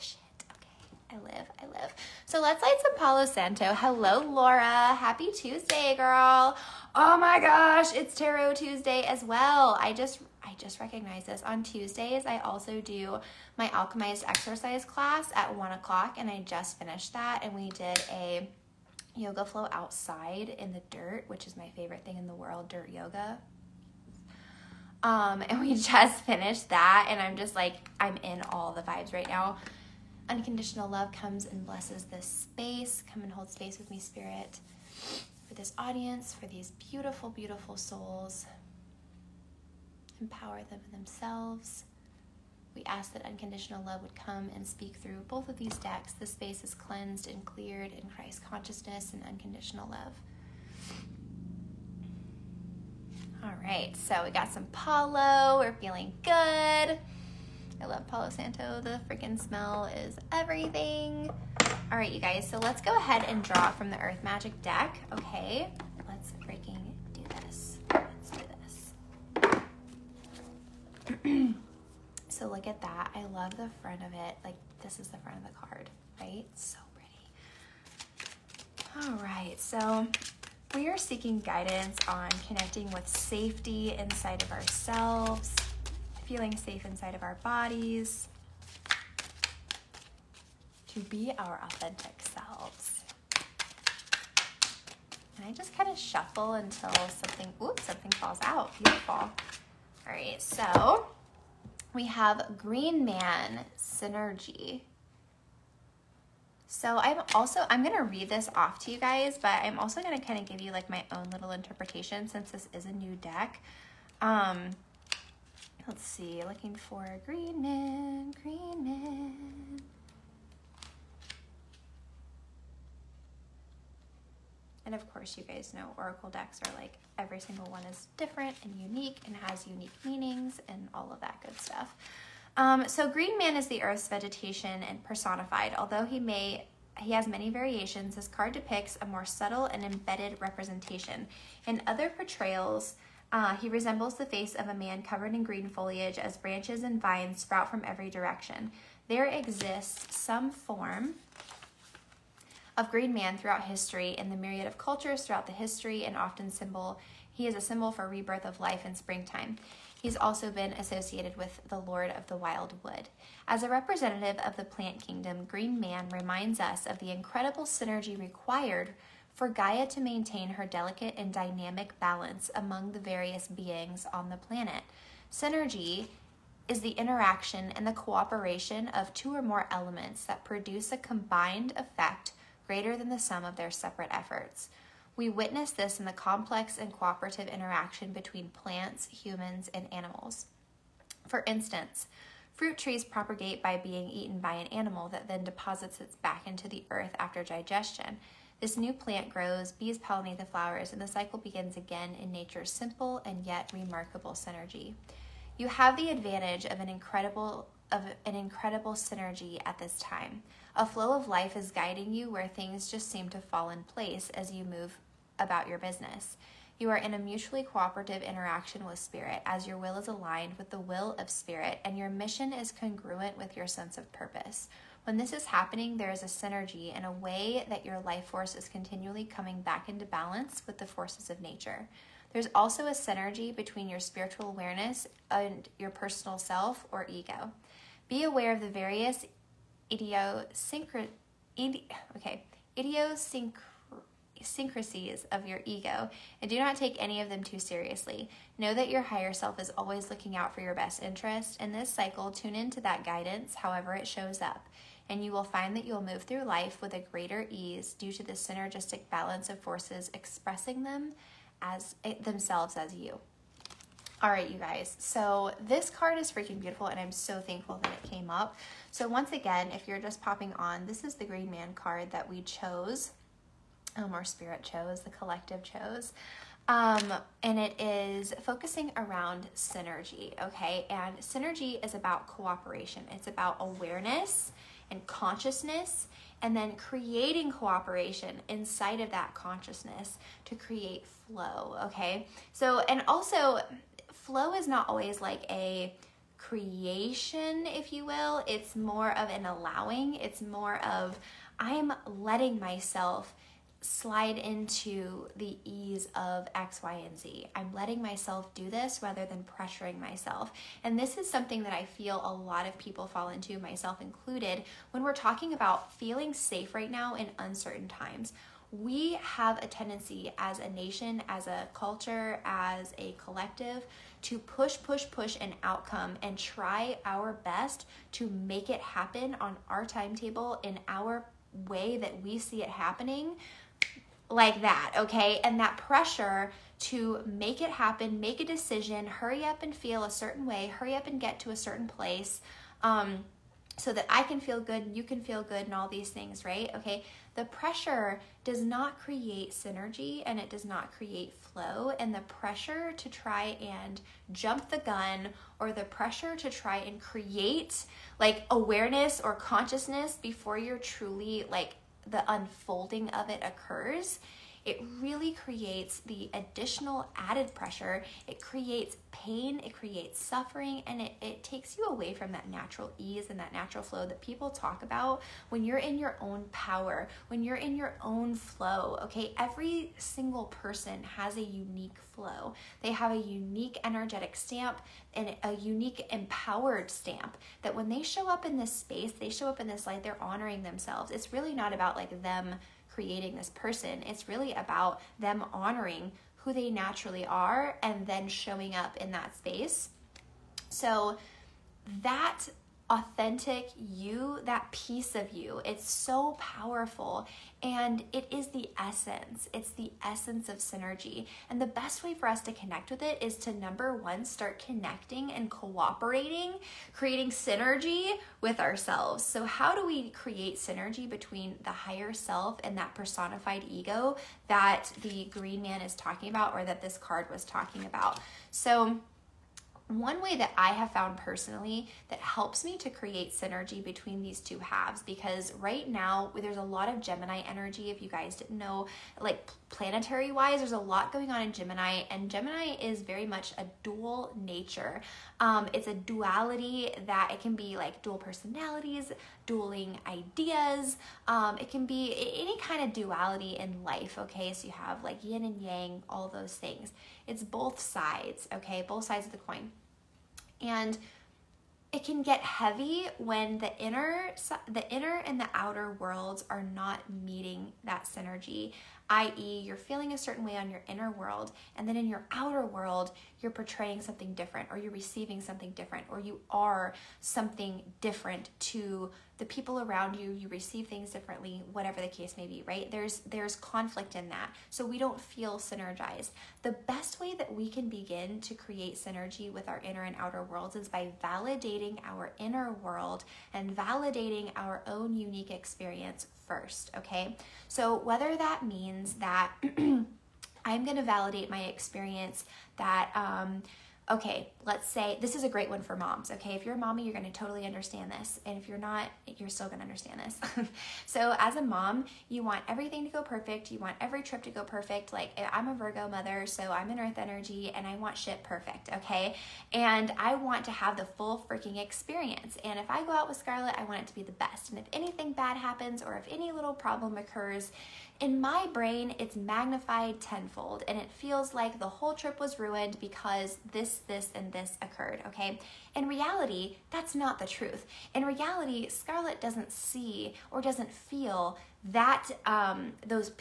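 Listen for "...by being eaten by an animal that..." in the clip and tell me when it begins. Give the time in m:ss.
3:13.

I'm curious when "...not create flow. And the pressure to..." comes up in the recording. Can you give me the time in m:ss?
5:50.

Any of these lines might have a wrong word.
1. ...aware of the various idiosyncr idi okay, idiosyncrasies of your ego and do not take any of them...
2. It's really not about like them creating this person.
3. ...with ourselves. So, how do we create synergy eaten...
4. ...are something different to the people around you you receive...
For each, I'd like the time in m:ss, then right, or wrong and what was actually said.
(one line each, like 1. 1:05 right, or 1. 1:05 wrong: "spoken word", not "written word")
1. 3:58 right
2. 6:31 right
3. 6:58 wrong: "between", not "eaten"
4. 7:56 right.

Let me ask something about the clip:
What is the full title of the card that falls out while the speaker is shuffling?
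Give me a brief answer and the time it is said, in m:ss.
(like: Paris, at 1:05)
Green Man Synergy, at 1:42.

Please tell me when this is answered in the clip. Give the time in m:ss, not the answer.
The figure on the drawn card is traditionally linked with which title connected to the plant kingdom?
2:41.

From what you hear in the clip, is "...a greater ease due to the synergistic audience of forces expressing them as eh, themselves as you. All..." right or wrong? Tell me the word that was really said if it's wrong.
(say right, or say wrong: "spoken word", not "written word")
wrong: "balance", not "audience".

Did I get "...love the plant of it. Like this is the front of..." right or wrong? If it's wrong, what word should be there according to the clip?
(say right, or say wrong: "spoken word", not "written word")
wrong: "front", not "plant".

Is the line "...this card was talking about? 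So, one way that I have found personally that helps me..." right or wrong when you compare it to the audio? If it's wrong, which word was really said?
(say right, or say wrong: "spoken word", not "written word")
right.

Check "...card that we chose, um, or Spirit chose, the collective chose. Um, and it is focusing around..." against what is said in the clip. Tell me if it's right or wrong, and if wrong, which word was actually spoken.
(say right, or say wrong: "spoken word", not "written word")
right.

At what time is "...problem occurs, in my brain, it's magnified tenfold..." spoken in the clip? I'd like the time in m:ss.
8:46.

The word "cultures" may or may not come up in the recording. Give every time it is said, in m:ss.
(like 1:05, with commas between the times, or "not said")
2:34, 5:21.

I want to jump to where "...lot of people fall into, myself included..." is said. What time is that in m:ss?
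5:12.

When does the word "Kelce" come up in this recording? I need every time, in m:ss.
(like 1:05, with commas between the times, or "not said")
not said.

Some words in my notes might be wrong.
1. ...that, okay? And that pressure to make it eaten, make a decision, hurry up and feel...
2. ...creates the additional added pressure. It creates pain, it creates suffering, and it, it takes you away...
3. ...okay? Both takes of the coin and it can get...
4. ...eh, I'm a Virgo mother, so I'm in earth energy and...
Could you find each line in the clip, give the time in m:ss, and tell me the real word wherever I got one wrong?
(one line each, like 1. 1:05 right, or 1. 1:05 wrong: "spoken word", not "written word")
1. 5:34 wrong: "happen", not "eaten"
2. 6:05 right
3. 7:38 wrong: "sides", not "takes"
4. 8:35 right.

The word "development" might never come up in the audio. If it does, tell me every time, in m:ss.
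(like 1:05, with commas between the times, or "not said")
not said.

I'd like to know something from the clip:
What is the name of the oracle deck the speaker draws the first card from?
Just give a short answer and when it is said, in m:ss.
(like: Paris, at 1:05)
Earth Magic, at 1:03.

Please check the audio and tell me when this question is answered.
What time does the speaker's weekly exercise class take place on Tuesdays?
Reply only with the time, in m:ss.
0:15.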